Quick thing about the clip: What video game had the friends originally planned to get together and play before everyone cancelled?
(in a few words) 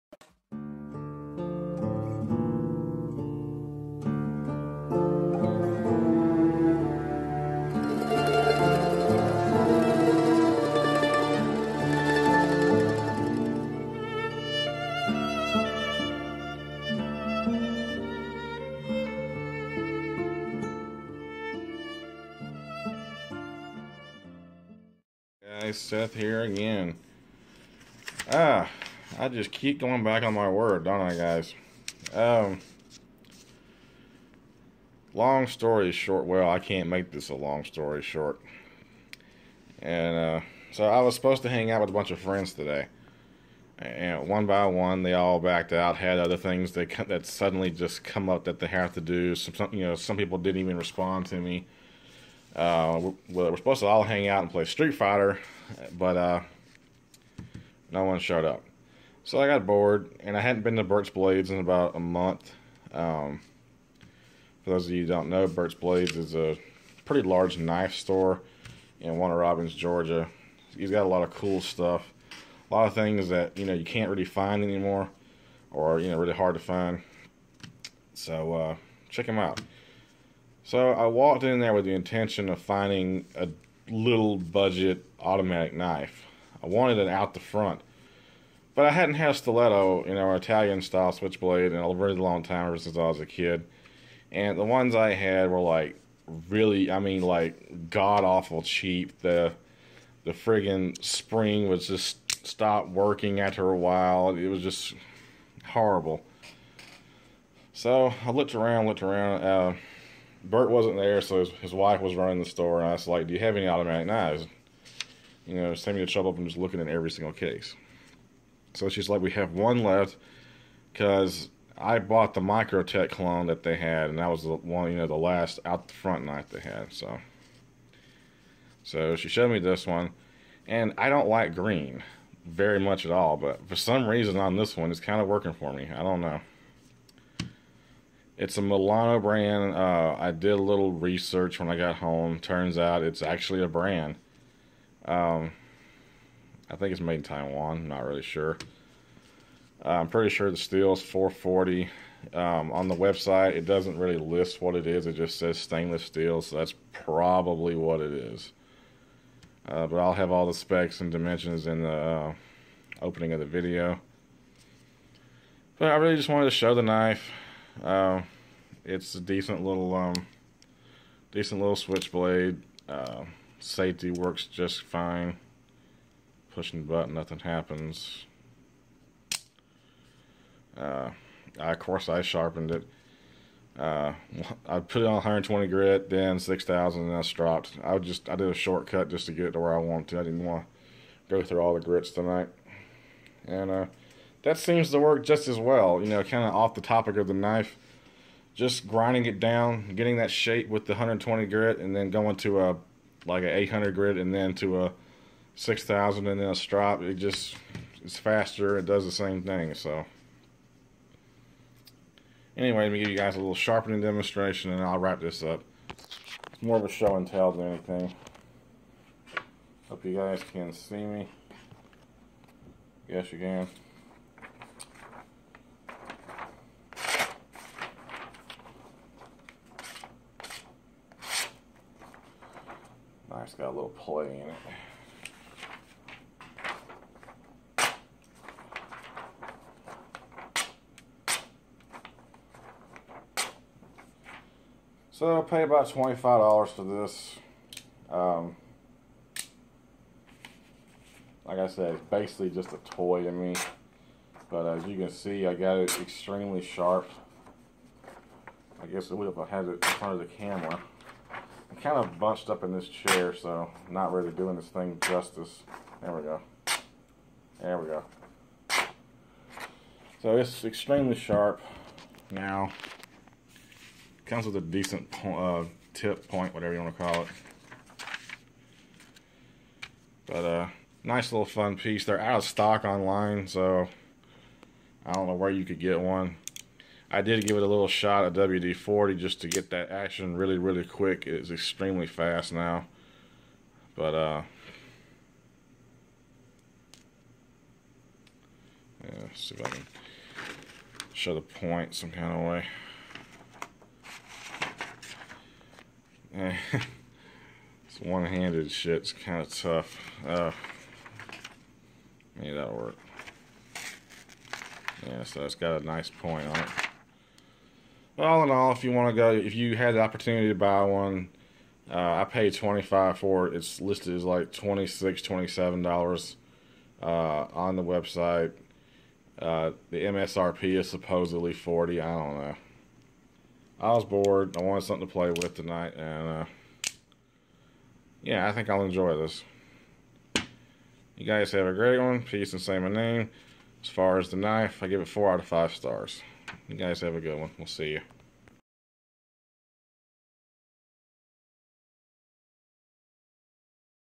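Street Fighter.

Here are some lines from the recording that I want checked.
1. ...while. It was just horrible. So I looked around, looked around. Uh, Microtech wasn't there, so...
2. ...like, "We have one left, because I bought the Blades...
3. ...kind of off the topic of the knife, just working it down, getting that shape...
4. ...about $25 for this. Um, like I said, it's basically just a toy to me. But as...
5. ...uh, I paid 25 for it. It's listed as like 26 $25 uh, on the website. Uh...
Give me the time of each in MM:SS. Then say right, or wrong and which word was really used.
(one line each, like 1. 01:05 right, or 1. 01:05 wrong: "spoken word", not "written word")
1. 01:43 wrong: "Bert", not "Microtech"
2. 01:59 wrong: "Microtech", not "Blades"
3. 03:16 wrong: "grinding", not "working"
4. 04:05 right
5. 05:21 wrong: "27", not "25".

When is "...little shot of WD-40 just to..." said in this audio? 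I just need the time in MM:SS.
04:47.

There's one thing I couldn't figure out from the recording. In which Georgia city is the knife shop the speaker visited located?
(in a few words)
Warner Robins.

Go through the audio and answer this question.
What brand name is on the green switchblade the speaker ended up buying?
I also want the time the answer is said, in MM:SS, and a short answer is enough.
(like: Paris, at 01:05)
Milano, at 02:18.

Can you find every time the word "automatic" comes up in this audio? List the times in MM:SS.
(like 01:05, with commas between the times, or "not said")
01:25, 01:53.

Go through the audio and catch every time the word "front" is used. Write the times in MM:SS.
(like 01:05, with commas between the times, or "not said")
01:27, 02:05, 04:19.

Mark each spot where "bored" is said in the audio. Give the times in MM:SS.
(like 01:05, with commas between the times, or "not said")
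00:59, 05:34.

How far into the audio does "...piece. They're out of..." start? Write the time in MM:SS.
04:41.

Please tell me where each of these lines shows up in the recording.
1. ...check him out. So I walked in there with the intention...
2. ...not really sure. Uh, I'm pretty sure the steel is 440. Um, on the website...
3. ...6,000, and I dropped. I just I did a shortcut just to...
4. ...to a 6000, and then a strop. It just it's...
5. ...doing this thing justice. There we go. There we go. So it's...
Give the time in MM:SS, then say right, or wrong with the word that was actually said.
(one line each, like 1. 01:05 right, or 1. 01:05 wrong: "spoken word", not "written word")
1. 01:19 right
2. 02:27 right
3. 03:06 right
4. 03:24 right
5. 04:24 right.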